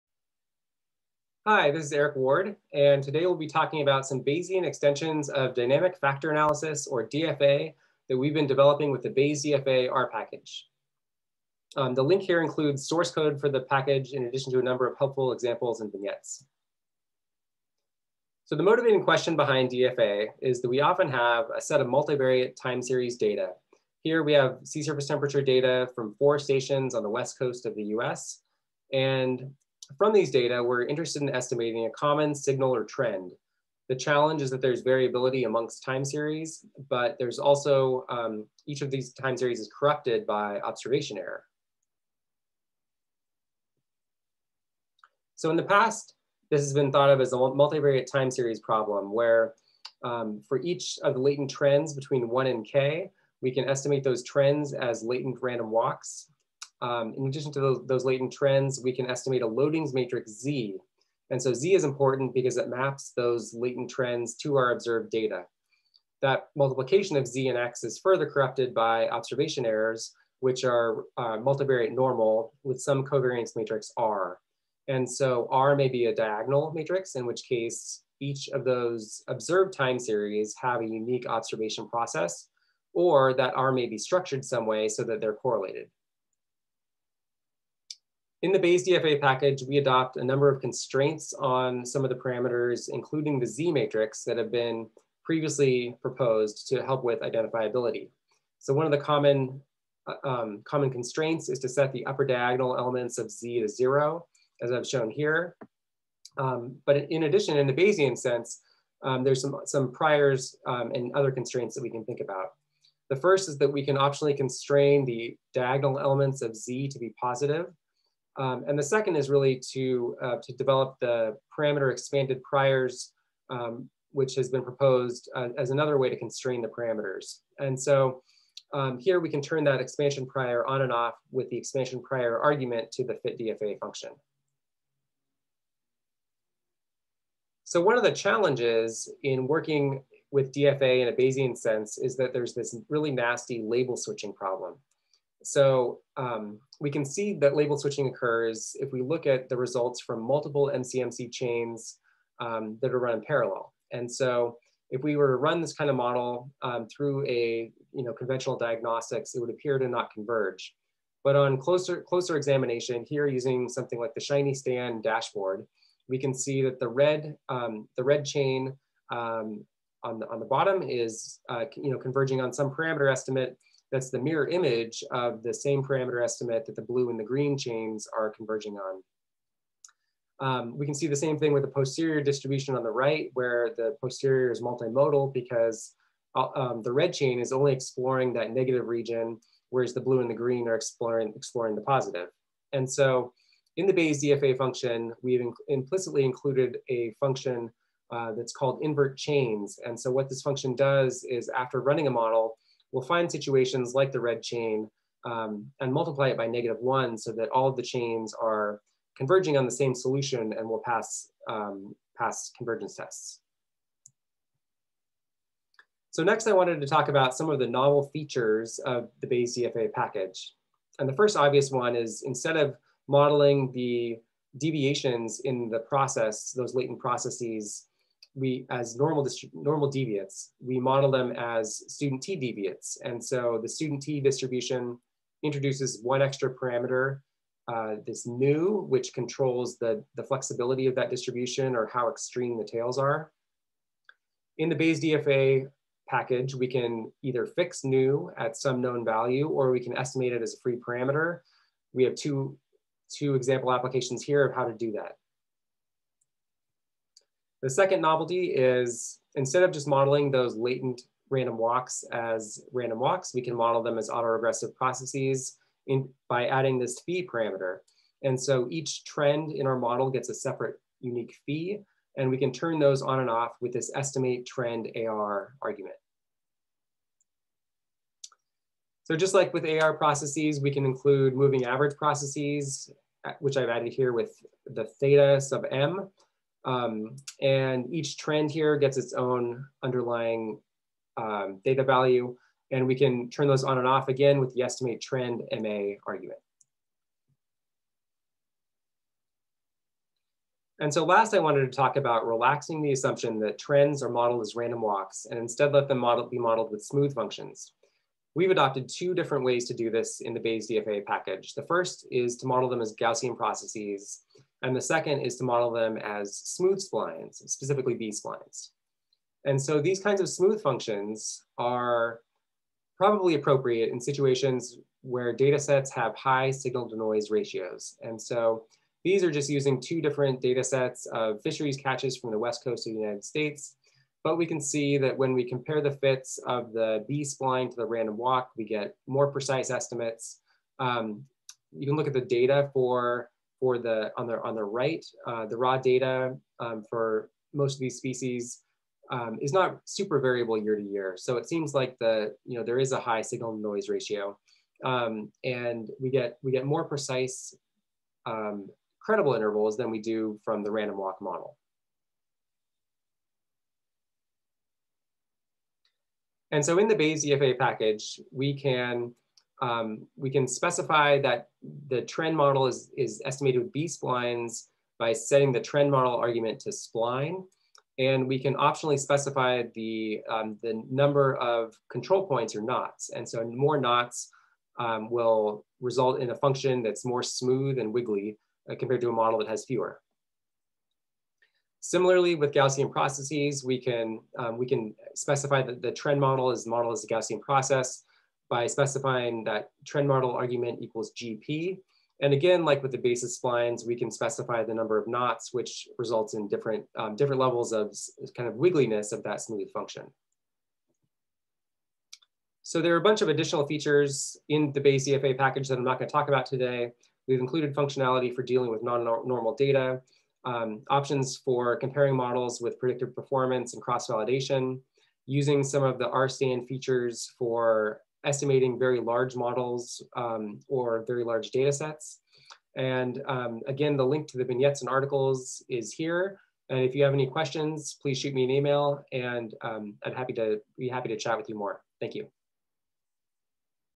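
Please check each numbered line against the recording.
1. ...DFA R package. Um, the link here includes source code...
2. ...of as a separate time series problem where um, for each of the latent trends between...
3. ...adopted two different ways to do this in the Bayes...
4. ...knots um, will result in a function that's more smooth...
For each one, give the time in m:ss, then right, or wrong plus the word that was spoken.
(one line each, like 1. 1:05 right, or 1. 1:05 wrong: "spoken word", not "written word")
1. 0:09 right
2. 0:47 wrong: "multivariate", not "separate"
3. 5:08 right
4. 6:23 right.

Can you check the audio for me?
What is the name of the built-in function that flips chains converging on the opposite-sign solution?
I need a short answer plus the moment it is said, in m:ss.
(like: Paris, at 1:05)
invert chains, at 3:18.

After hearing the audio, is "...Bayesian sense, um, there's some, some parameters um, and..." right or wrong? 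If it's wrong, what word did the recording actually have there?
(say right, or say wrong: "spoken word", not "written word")
wrong: "priors", not "parameters".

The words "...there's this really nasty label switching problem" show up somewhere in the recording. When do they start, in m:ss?
2:22.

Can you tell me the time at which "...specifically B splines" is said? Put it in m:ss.
5:17.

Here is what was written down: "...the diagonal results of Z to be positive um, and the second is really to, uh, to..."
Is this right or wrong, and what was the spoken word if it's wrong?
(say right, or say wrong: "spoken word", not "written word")
wrong: "elements", not "results".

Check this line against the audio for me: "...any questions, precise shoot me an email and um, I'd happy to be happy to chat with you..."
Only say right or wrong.
wrong.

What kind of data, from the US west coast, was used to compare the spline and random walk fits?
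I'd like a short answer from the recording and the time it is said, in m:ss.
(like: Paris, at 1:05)
fisheries catches, at 5:31.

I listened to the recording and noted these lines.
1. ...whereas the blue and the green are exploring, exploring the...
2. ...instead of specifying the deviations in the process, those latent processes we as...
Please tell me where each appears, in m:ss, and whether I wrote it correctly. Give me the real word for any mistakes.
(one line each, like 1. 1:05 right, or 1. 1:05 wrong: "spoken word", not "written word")
1. 3:09 right
2. 3:42 wrong: "modeling", not "specifying".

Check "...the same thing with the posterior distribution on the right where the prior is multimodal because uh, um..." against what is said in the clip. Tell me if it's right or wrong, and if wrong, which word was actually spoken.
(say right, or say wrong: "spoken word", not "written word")
wrong: "posterior", not "prior".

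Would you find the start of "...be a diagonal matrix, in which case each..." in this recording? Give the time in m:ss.
1:15.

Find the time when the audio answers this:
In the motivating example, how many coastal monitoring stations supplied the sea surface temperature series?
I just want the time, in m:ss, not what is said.
0:26.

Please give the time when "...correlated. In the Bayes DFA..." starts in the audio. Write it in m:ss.
1:25.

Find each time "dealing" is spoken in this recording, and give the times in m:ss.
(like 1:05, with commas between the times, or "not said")
6:58.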